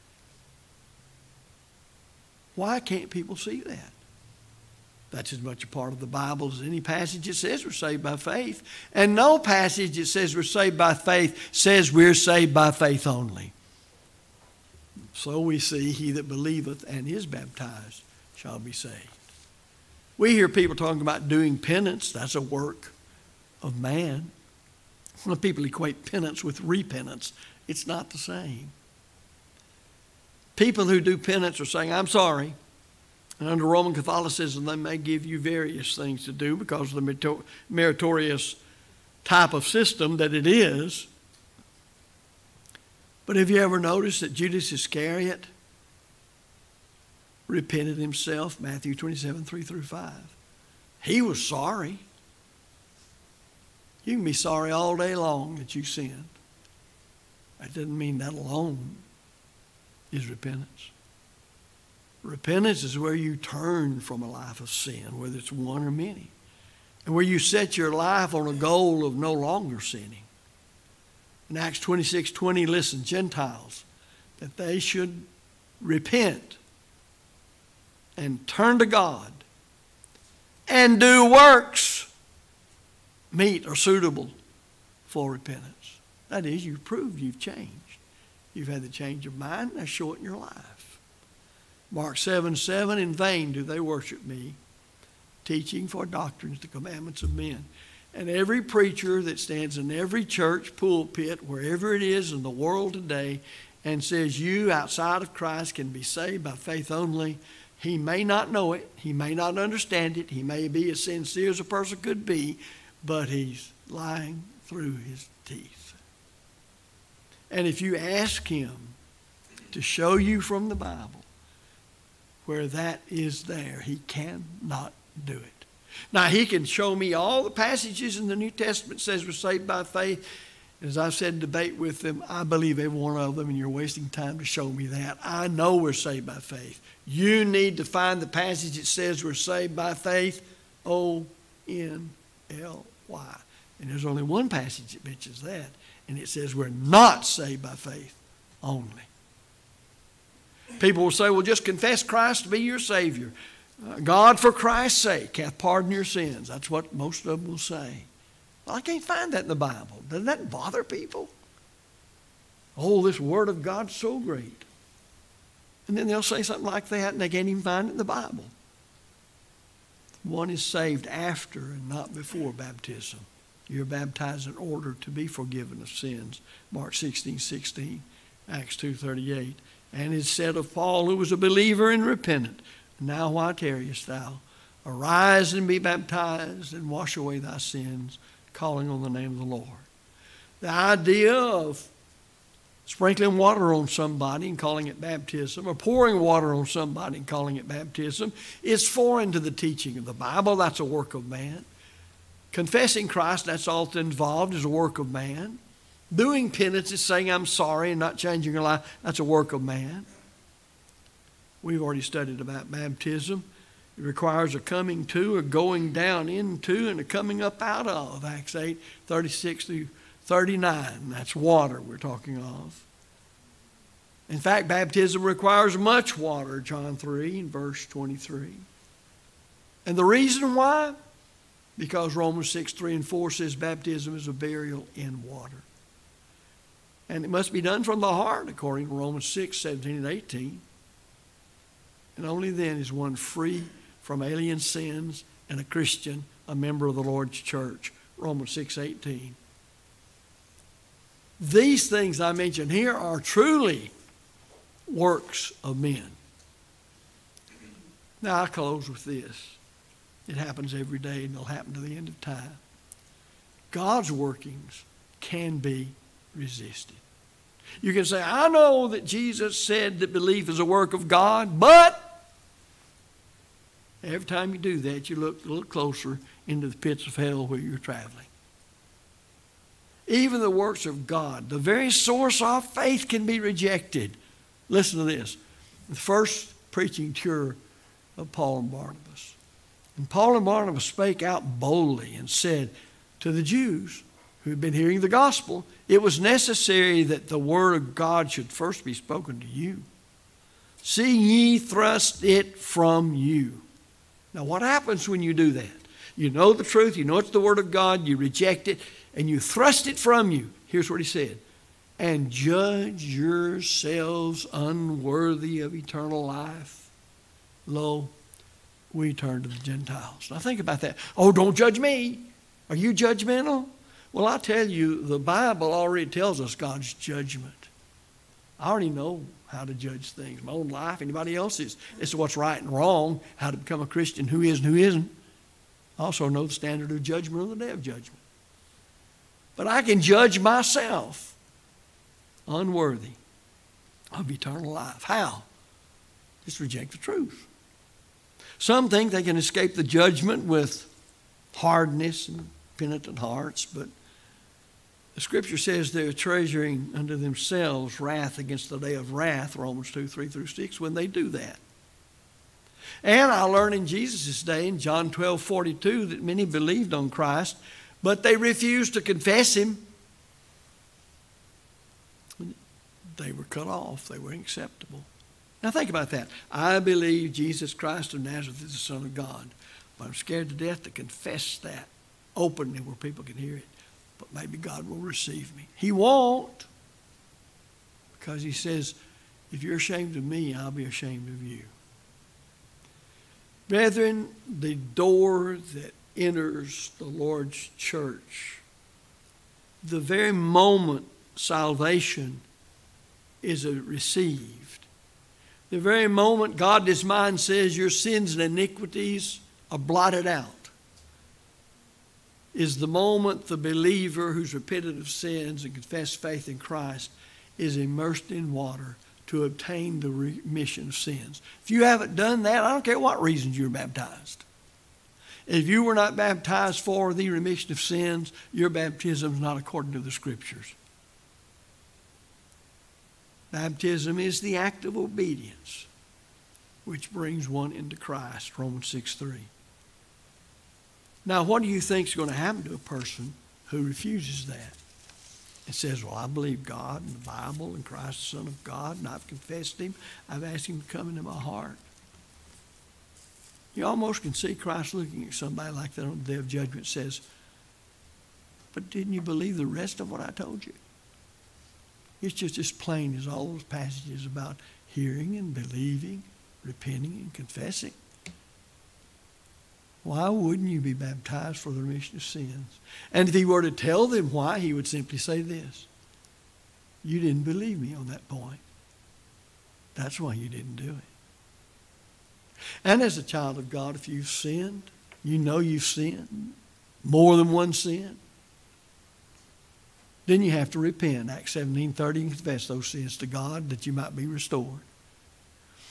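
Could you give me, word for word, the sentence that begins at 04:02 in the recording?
And only then is one free from alien sins and a Christian, a member of the Lord's church.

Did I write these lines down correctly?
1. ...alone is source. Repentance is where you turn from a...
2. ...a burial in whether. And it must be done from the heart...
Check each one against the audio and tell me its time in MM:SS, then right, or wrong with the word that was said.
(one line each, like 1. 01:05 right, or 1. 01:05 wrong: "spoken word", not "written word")
1. 00:58 wrong: "repentance", not "source"
2. 03:54 wrong: "water", not "whether".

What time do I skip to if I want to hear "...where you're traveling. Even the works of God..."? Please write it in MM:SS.
04:37.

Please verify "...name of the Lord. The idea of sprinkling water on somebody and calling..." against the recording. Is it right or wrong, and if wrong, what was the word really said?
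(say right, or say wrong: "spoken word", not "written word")
right.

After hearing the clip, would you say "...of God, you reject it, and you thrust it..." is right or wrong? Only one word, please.
right.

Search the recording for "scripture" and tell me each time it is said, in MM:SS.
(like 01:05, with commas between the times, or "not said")
05:55, 07:10.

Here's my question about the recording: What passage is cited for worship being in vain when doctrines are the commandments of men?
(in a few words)
Mark 7:7.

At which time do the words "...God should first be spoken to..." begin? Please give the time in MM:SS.
04:57.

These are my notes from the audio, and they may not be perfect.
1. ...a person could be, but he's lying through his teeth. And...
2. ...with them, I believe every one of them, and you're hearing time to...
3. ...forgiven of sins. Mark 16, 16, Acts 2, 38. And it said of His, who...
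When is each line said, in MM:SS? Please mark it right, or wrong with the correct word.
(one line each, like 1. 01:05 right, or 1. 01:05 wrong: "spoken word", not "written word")
1. 01:51 right
2. 02:11 wrong: "wasting", not "hearing"
3. 02:55 wrong: "Paul", not "His".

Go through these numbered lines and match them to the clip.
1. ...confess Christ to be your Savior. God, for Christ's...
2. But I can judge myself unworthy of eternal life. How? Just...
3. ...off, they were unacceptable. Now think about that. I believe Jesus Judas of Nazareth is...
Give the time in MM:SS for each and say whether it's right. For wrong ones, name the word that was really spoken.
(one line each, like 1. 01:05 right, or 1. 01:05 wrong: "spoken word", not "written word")
1. 02:31 right
2. 05:39 right
3. 06:13 wrong: "Christ", not "Judas".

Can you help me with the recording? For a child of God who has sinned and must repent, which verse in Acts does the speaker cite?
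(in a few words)
Acts 17:30.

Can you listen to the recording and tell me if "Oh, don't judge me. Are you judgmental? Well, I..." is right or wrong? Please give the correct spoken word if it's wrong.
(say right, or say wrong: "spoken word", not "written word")
right.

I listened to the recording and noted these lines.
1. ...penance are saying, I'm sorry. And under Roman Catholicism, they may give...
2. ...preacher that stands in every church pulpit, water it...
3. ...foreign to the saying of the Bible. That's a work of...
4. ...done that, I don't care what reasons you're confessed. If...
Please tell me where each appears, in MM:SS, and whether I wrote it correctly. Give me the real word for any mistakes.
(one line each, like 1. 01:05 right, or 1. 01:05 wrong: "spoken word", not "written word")
1. 00:31 right
2. 01:38 wrong: "wherever", not "water"
3. 03:18 wrong: "teaching", not "saying"
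4. 07:02 wrong: "baptized", not "confessed".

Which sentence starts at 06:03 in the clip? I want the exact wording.
And I learned in Jesus' day in John 12, 42 that many believed on Christ, but they refused to confess him.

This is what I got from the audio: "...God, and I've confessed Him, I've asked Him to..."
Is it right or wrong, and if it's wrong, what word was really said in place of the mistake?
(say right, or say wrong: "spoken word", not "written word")
right.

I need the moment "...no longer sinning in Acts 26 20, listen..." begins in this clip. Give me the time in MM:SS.
01:09.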